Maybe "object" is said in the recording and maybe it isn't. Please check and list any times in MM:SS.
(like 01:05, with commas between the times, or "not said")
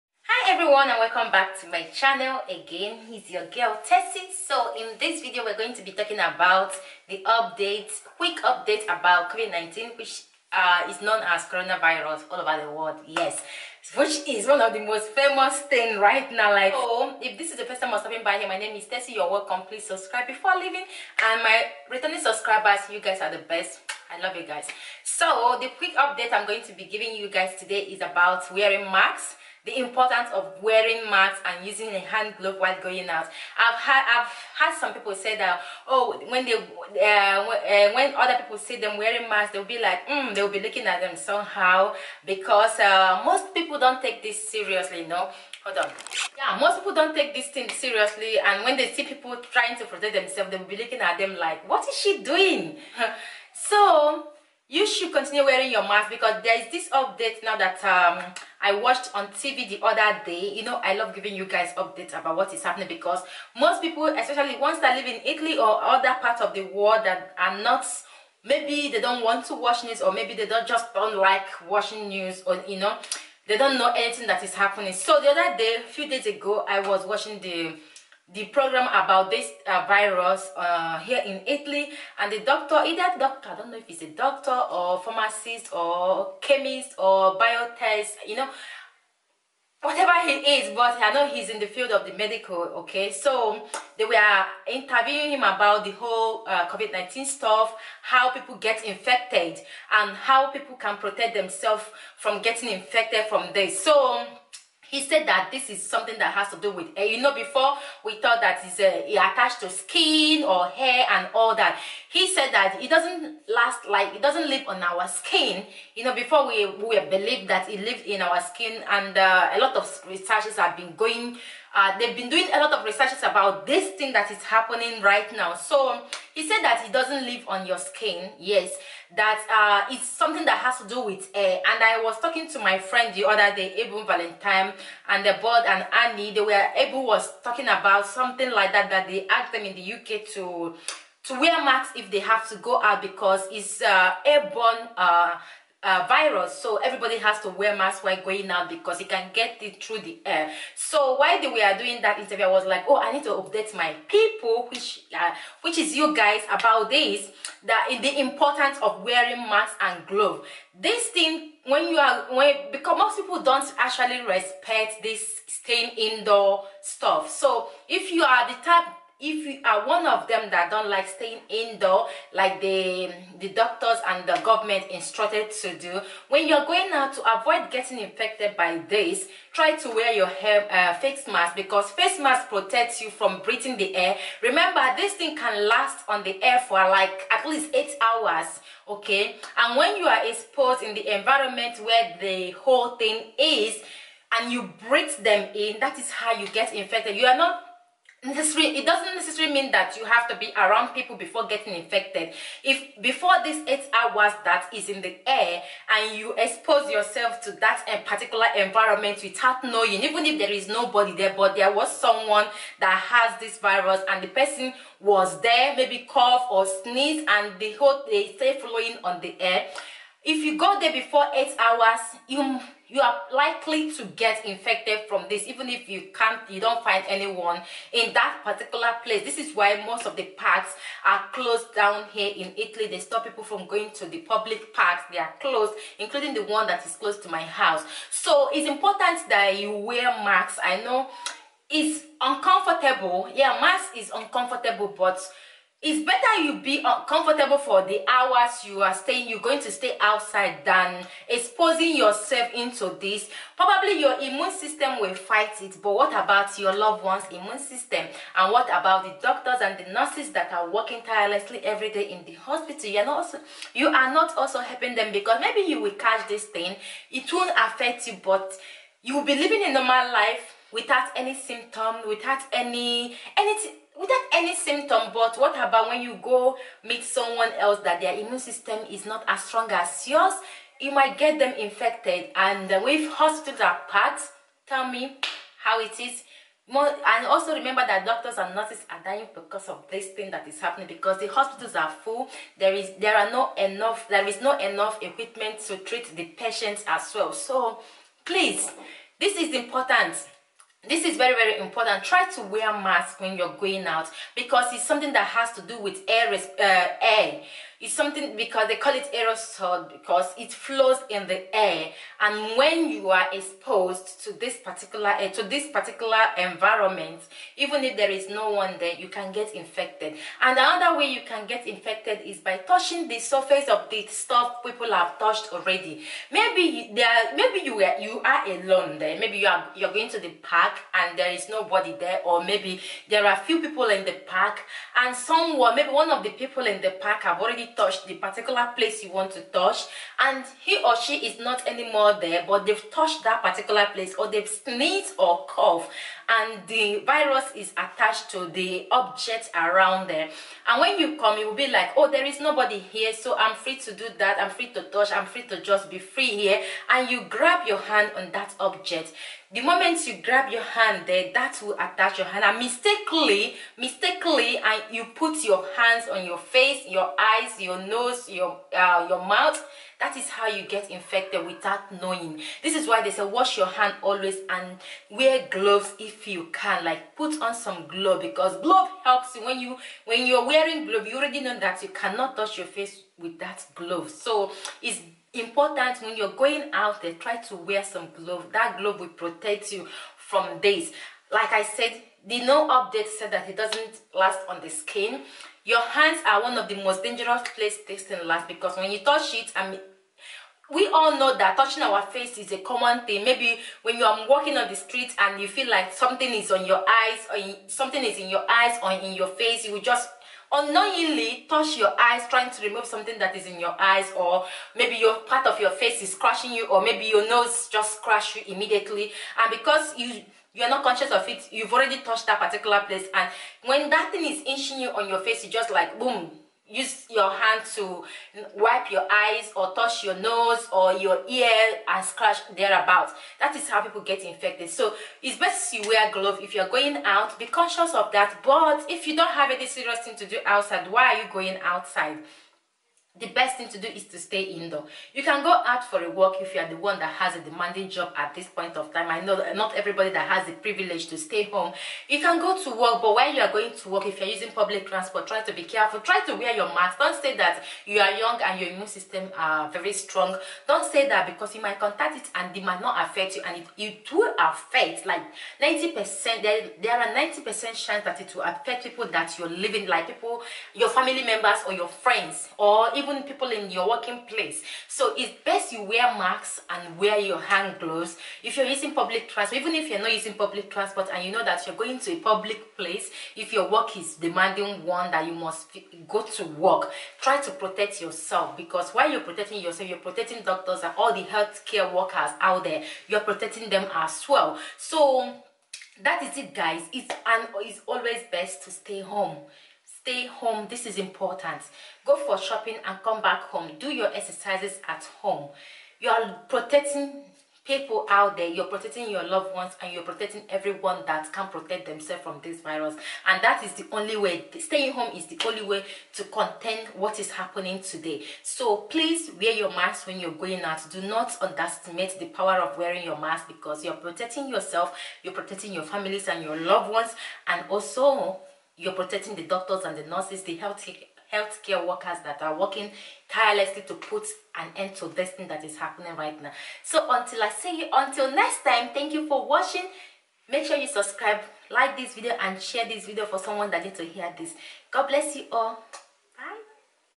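05:48, 05:58.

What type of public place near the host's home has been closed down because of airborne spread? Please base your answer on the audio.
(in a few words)
public parks.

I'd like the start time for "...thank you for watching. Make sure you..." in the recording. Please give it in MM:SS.
08:58.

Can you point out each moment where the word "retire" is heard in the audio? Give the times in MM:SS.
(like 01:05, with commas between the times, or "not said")
not said.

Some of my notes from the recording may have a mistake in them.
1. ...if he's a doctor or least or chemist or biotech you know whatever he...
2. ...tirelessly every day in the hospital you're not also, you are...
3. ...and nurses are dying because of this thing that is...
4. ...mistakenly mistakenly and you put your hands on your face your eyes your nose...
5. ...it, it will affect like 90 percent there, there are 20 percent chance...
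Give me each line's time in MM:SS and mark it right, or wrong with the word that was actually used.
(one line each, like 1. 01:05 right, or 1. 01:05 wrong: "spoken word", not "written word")
1. 01:23 wrong: "pharmacist", not "least"
2. 04:21 right
3. 04:48 right
4. 06:02 right
5. 07:43 wrong: "90", not "20".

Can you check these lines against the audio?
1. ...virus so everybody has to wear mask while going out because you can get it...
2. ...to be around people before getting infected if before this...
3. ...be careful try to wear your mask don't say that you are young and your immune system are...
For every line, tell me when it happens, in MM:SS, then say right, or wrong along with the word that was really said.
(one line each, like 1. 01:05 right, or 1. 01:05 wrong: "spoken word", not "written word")
1. 02:26 right
2. 03:20 right
3. 07:35 right.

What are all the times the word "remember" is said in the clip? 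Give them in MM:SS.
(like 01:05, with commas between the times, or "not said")
03:04, 04:47.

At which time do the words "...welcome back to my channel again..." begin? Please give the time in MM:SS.
00:00.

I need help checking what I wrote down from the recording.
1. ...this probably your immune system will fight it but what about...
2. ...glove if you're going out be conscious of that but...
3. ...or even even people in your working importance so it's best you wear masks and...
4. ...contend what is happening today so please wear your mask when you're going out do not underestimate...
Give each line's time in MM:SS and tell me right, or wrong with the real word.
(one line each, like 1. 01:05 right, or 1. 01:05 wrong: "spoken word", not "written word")
1. 04:13 right
2. 07:16 right
3. 07:52 wrong: "place", not "importance"
4. 08:36 right.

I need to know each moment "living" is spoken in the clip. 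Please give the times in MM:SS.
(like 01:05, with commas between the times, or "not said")
04:29, 07:49.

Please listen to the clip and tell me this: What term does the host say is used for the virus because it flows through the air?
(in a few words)
aerosol.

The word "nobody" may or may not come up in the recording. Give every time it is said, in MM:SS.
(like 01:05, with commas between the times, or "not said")
03:30, 05:31, 05:52.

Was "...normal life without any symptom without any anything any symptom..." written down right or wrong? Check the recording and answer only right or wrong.
right.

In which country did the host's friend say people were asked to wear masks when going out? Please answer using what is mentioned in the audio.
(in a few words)
UK.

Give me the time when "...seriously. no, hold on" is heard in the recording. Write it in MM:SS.
00:44.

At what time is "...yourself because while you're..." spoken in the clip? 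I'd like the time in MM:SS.
08:08.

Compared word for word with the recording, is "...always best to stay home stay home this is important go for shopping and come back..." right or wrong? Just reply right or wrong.
right.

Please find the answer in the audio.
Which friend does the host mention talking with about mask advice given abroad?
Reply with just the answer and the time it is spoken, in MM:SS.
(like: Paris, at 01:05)
Abel Valentine, at 02:13.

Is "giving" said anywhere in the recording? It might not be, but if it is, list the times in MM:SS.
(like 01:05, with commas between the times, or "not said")
00:26, 01:01.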